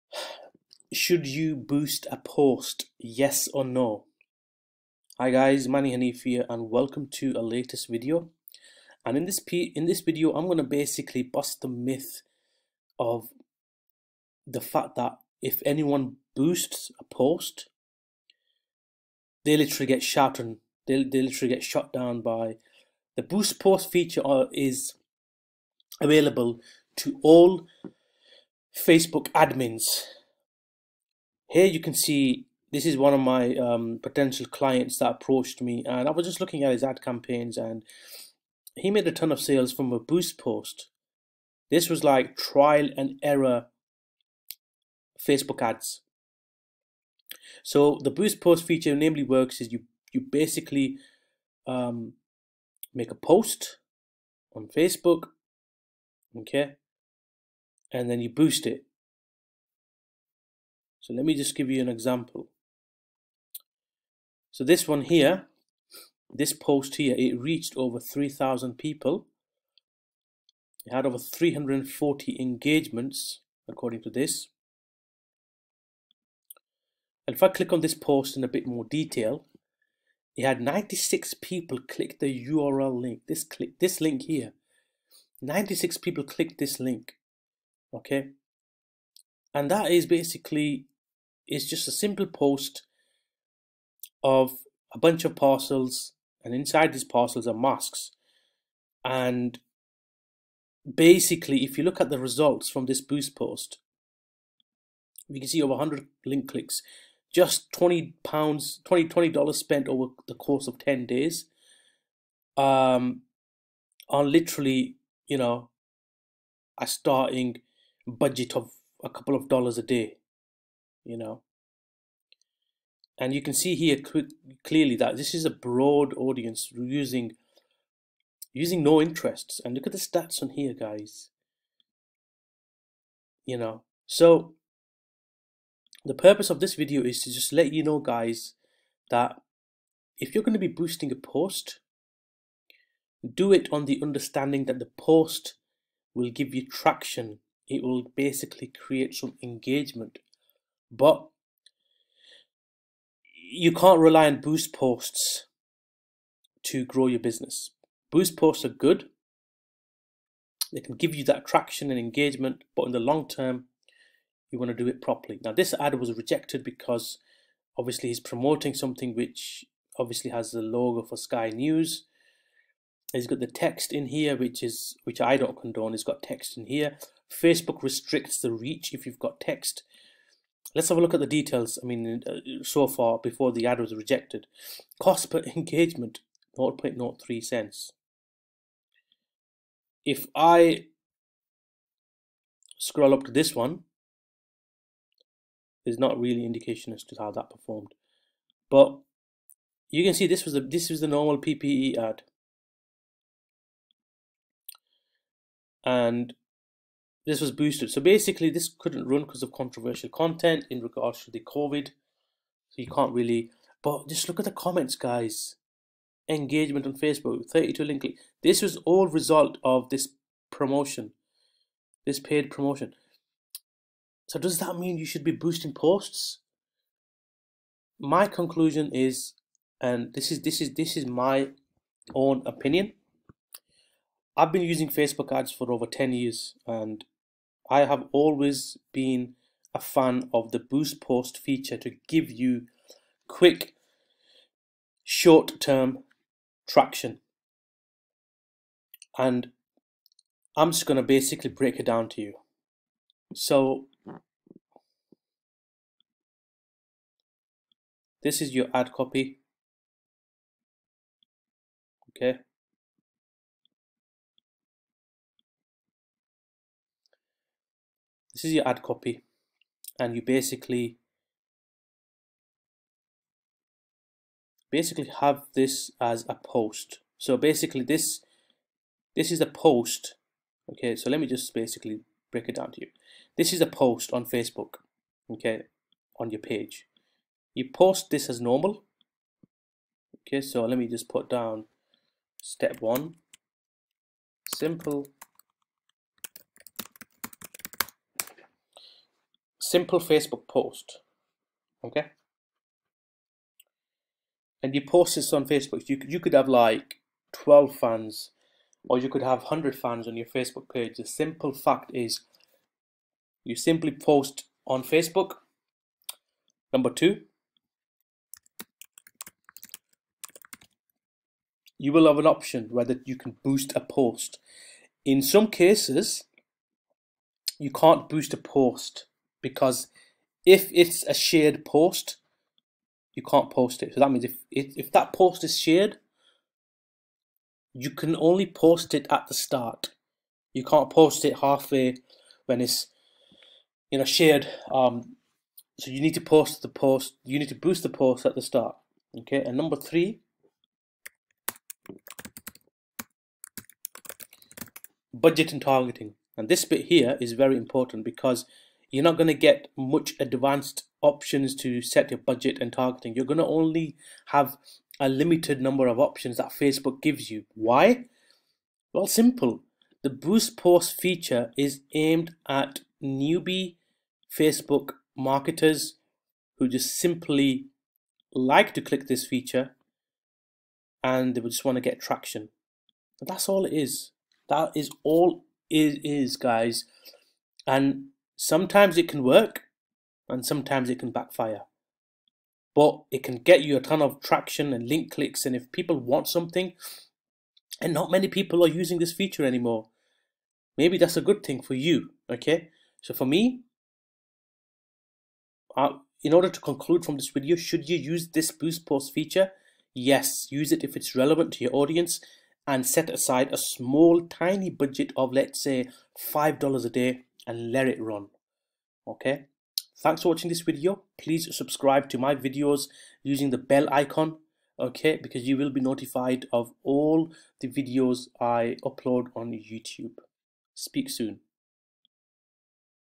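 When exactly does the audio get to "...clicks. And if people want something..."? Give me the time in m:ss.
6:35.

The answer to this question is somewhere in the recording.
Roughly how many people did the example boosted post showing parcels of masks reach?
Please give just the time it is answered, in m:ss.
1:07.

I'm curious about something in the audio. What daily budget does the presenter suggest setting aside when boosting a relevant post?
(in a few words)
$5 a day.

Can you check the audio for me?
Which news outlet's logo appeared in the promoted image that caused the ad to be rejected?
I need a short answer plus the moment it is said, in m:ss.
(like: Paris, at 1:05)
Sky News, at 2:51.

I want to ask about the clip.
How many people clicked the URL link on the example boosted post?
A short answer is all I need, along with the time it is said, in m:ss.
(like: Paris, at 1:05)
96, at 1:20.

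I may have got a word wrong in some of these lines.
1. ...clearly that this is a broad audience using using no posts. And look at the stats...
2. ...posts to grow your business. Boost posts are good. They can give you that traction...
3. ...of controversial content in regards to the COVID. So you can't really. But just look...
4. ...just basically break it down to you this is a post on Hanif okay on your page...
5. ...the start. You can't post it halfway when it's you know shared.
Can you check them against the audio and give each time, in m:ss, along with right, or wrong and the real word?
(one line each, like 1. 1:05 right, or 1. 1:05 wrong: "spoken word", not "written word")
1. 2:04 wrong: "interests", not "posts"
2. 2:34 right
3. 3:29 right
4. 4:41 wrong: "Facebook", not "Hanif"
5. 5:39 right.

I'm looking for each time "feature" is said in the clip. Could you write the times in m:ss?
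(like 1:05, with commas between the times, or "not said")
0:23, 0:48, 4:01, 6:10, 6:19, 6:39, 6:49.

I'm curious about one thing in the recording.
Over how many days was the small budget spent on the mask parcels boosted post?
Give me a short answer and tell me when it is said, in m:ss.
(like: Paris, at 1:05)
10 days, at 1:50.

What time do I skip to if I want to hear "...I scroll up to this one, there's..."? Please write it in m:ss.
3:10.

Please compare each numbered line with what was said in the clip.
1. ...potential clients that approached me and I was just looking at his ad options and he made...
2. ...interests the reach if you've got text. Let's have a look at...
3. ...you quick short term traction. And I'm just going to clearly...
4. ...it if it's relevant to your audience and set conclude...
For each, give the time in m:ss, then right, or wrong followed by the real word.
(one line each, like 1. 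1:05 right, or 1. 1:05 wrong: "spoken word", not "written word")
1. 0:34 wrong: "campaigns", not "options"
2. 2:57 wrong: "restricts", not "interests"
3. 4:02 wrong: "basically", not "clearly"
4. 6:50 wrong: "aside", not "conclude".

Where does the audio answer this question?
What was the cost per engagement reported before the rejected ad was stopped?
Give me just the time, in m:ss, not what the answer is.
3:06.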